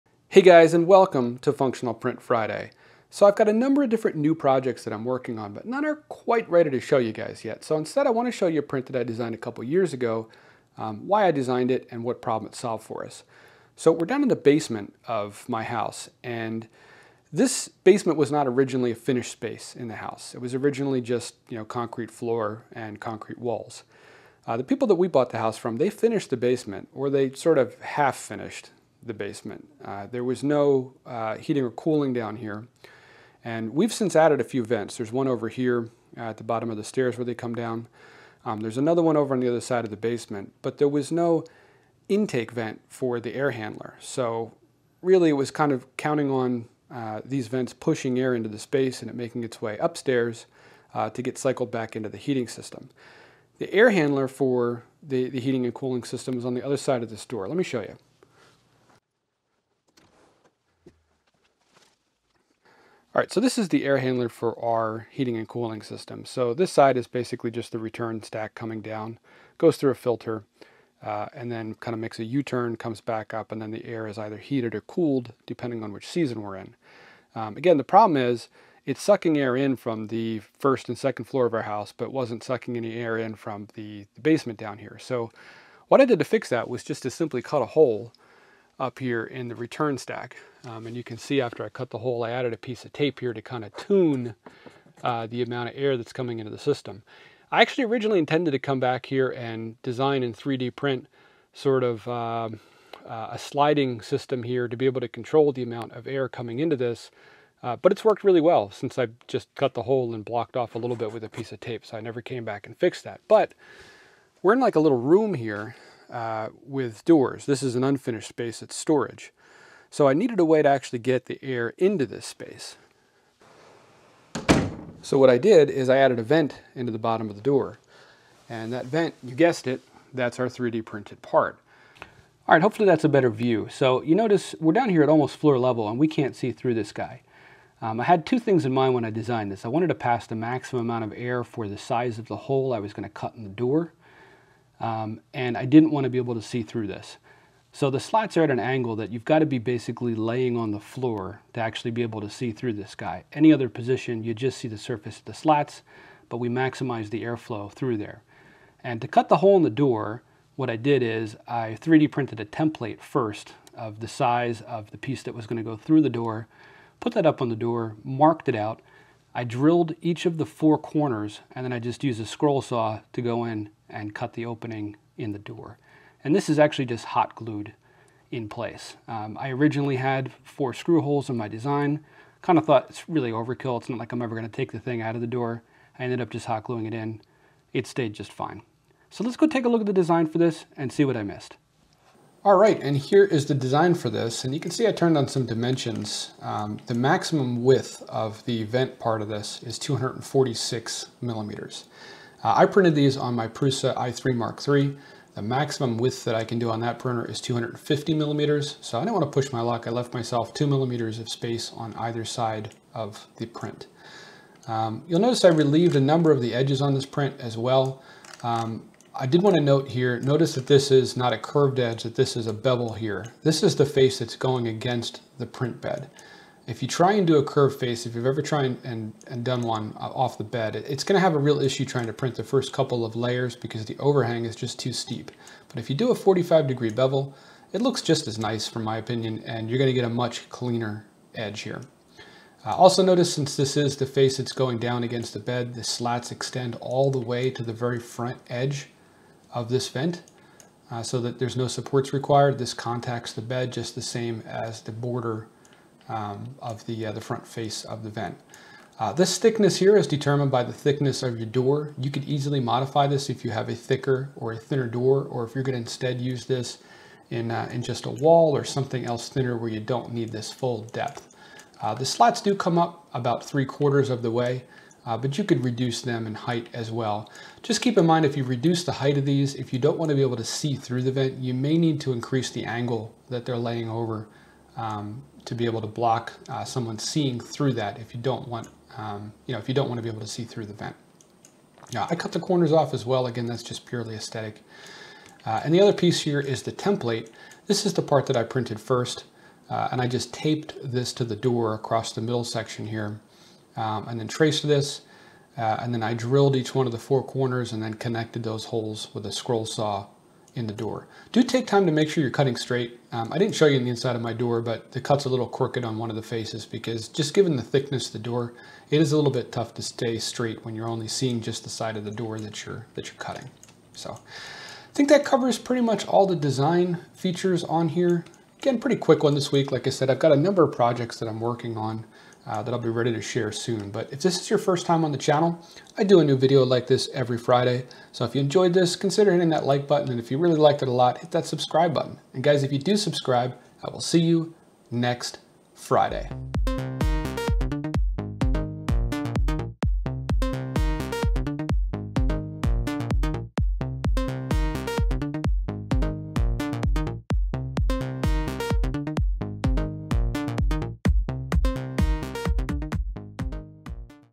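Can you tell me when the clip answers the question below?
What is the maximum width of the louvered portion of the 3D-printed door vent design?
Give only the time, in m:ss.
3:19.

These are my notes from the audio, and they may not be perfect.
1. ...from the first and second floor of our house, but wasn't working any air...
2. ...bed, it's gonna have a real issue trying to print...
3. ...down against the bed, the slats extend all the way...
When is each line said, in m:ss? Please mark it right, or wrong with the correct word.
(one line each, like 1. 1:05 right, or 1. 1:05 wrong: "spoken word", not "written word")
1. 1:19 wrong: "sucking", not "working"
2. 3:50 right
3. 4:04 right.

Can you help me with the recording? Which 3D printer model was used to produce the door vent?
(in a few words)
Prusa i3 Mark III.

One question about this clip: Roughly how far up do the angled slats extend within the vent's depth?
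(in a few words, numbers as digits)
Three quarters.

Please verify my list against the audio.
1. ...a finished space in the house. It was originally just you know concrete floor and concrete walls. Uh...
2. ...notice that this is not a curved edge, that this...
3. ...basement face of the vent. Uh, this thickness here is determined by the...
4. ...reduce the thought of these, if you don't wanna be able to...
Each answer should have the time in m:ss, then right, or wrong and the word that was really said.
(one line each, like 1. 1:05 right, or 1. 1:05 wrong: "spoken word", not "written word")
1. 0:18 right
2. 3:40 right
3. 4:17 wrong: "front", not "basement"
4. 4:38 wrong: "height", not "thought".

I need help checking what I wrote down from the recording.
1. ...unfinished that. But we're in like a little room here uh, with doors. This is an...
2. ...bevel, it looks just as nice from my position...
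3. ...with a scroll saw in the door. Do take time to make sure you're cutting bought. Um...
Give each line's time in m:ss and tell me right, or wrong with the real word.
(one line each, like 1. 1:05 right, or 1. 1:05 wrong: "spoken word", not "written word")
1. 1:52 wrong: "fixed", not "unfinished"
2. 3:56 wrong: "opinion", not "position"
3. 5:09 wrong: "straight", not "bought".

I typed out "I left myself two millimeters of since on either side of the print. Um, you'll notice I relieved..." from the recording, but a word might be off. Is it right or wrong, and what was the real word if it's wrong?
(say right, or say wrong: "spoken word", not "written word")
wrong: "space", not "since".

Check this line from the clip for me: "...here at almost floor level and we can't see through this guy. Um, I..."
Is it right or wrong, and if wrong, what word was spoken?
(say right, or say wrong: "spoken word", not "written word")
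right.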